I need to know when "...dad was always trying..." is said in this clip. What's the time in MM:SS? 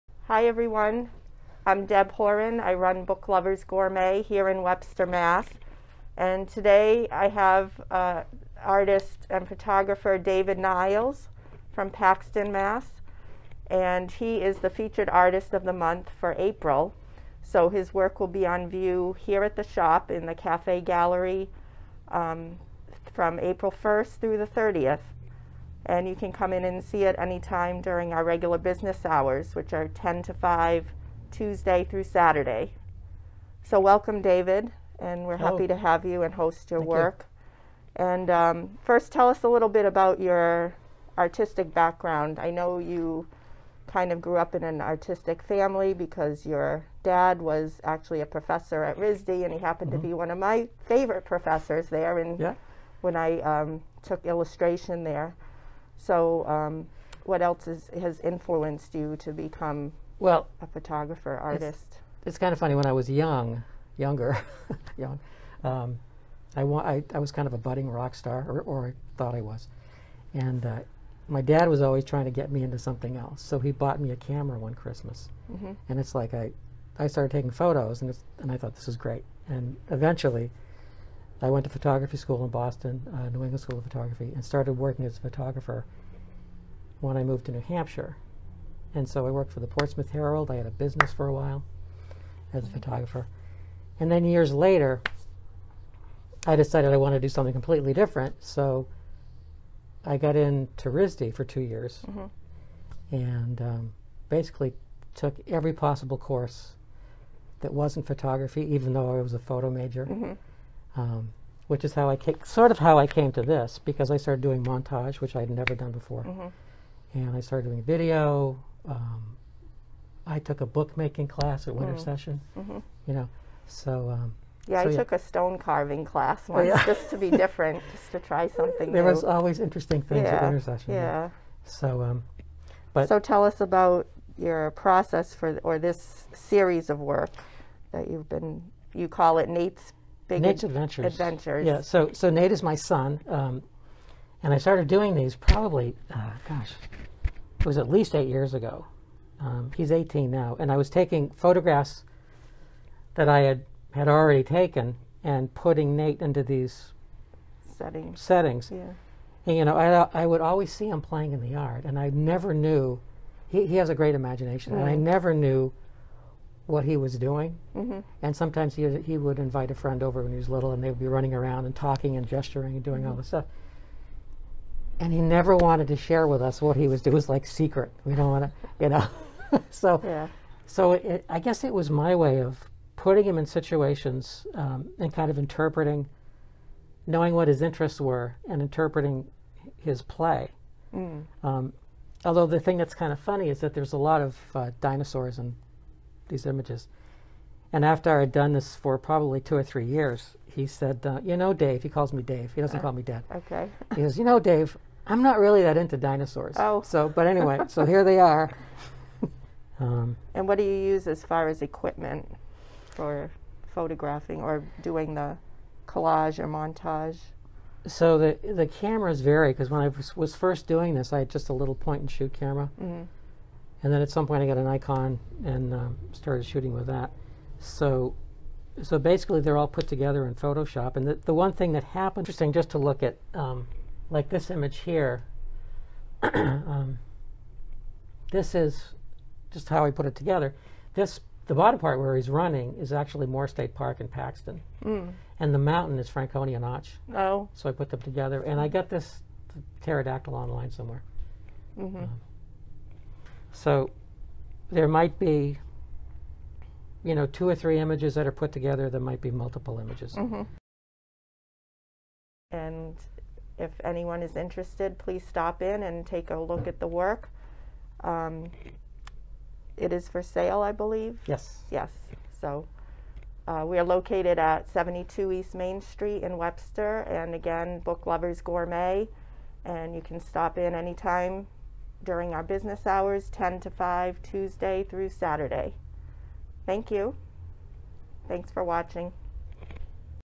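01:11.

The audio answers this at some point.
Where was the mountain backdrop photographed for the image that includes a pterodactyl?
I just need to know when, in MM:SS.
04:06.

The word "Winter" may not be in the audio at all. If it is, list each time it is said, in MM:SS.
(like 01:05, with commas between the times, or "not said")
02:01, 02:10.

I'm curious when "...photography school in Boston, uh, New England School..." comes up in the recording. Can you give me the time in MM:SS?
01:21.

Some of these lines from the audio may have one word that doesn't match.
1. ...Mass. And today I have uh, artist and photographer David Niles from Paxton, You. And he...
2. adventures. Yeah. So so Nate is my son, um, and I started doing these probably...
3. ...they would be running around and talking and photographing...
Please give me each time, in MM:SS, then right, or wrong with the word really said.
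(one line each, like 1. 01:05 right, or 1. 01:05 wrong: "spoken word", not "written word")
1. 00:05 wrong: "Mass", not "You"
2. 02:21 right
3. 02:50 wrong: "gesturing", not "photographing".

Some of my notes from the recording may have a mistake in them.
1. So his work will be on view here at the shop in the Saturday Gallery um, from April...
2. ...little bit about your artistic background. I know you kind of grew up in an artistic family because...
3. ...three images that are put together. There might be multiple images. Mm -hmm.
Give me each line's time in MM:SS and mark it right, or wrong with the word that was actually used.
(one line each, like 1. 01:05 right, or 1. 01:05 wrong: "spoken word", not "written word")
1. 00:17 wrong: "Cafe", not "Saturday"
2. 00:39 right
3. 04:17 right.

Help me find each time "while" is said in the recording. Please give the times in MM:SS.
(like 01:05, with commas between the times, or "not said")
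01:31.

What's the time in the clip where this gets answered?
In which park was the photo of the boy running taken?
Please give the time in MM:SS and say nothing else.
04:03.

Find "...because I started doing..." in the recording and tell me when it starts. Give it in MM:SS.
01:53.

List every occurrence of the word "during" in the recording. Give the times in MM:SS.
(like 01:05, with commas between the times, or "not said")
00:27, 04:42.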